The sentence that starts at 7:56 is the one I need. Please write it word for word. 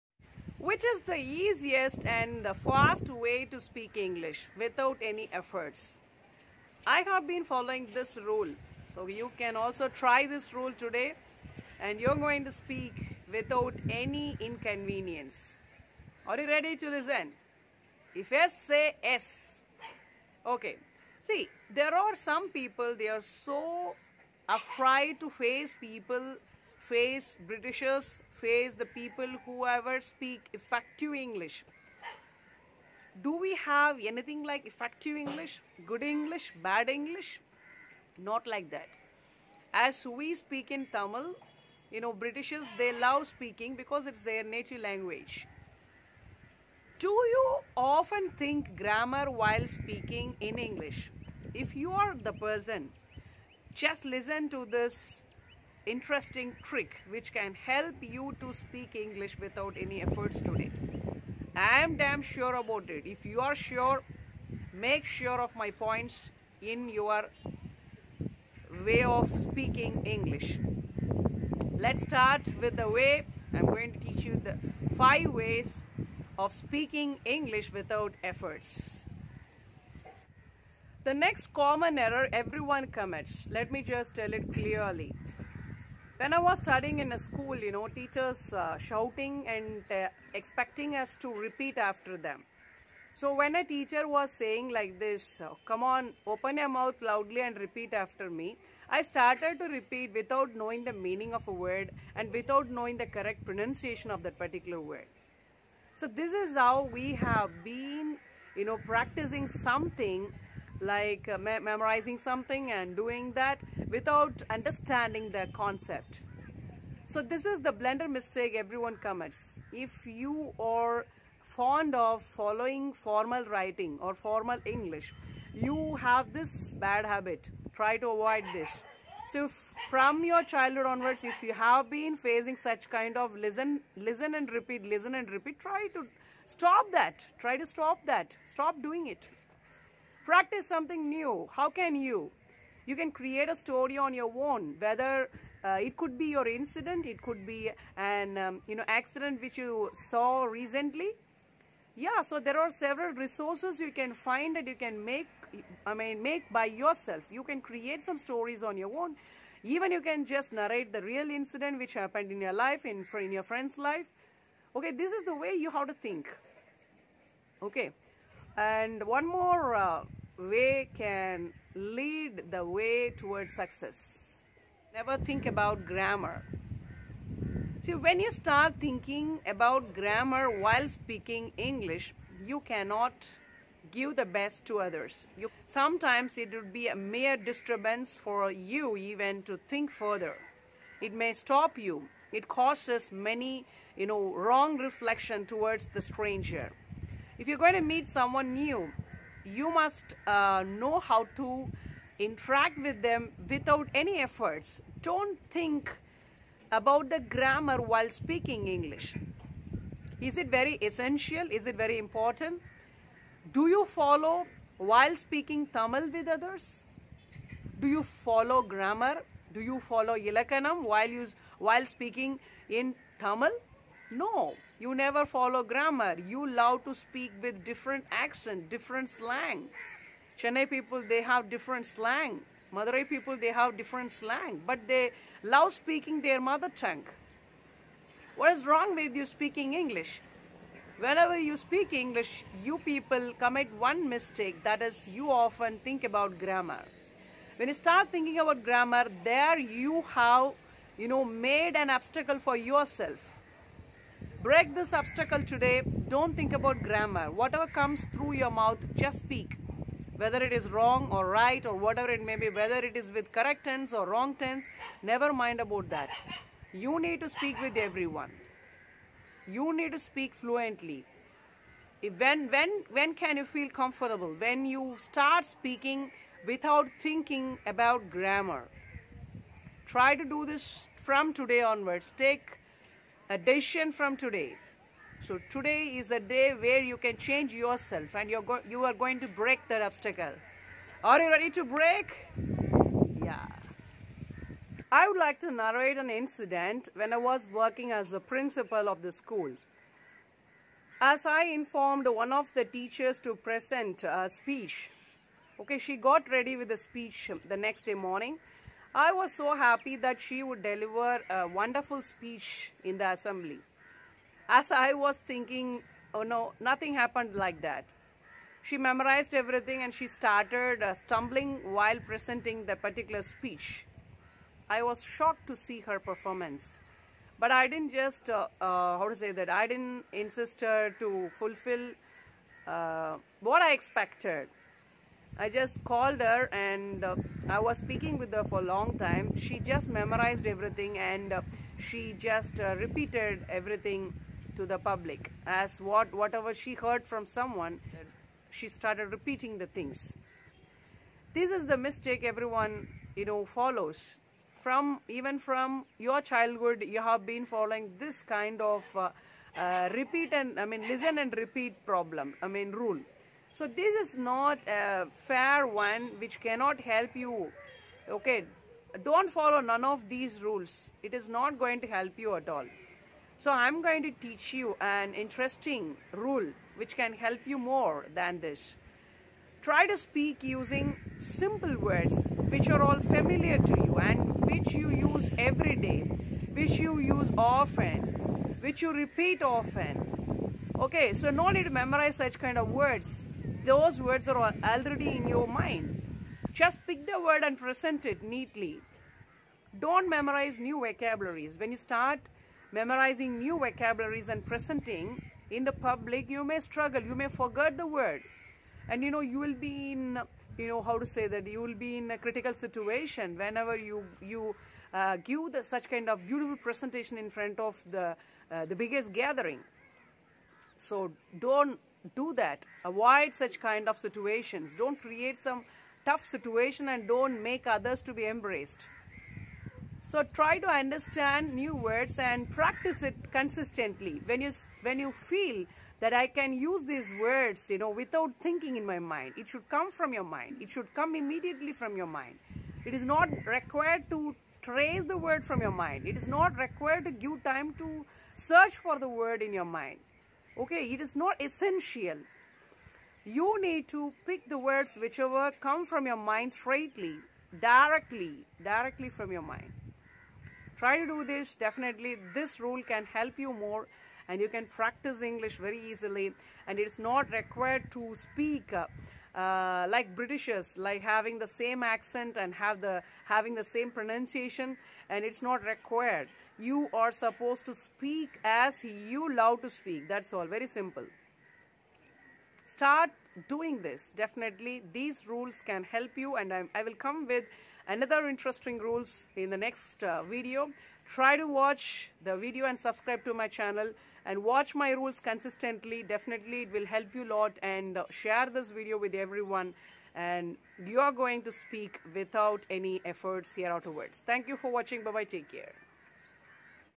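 You are supposed to speak as you love to speak.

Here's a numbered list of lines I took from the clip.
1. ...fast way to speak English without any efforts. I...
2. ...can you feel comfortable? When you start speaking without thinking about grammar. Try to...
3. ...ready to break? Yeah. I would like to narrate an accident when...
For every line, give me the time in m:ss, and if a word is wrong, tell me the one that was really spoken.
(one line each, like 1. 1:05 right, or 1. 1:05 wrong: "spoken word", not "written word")
1. 0:02 right
2. 4:33 right
3. 4:51 wrong: "incident", not "accident".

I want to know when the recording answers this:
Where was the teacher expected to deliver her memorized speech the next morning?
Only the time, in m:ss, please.
5:12.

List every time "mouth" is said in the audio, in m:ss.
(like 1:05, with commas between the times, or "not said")
1:36, 4:18.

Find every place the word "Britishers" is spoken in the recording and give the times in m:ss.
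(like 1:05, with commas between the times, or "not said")
0:27, 0:42, 7:50.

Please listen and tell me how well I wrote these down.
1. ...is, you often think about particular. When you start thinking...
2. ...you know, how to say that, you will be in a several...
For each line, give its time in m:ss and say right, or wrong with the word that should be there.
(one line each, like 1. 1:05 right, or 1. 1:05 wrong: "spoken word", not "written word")
1. 4:04 wrong: "grammar", not "particular"
2. 6:50 wrong: "critical", not "several".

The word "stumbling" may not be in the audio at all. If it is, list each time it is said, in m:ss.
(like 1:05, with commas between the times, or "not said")
5:20.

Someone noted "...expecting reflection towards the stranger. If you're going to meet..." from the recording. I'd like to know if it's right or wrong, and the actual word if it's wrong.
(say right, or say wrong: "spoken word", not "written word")
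wrong: "wrong", not "expecting".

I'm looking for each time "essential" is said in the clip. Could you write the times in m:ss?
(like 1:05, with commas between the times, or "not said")
3:30, 7:31.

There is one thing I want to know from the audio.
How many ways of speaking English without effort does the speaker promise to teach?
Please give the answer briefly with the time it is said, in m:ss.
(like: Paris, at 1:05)
5, at 1:14.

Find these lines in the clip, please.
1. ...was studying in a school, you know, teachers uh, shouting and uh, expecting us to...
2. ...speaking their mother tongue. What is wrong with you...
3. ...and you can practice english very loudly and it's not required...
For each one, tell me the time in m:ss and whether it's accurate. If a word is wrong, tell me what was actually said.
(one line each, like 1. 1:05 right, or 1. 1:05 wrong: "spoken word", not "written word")
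1. 1:26 right
2. 3:55 right
3. 7:44 wrong: "easily", not "loudly".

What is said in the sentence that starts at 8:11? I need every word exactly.
Try to watch the video and subscribe to my channel and watch my rules consistently.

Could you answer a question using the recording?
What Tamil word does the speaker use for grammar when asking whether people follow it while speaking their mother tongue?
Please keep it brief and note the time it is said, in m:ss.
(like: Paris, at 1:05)
Ilakanam, at 3:40.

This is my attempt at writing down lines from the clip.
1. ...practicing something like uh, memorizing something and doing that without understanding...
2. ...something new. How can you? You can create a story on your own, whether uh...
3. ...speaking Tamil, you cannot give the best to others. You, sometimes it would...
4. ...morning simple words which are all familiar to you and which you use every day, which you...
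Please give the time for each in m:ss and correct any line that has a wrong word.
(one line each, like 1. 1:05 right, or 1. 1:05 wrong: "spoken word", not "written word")
1. 1:48 right
2. 2:20 right
3. 3:00 wrong: "English", not "Tamil"
4. 6:20 wrong: "using", not "morning".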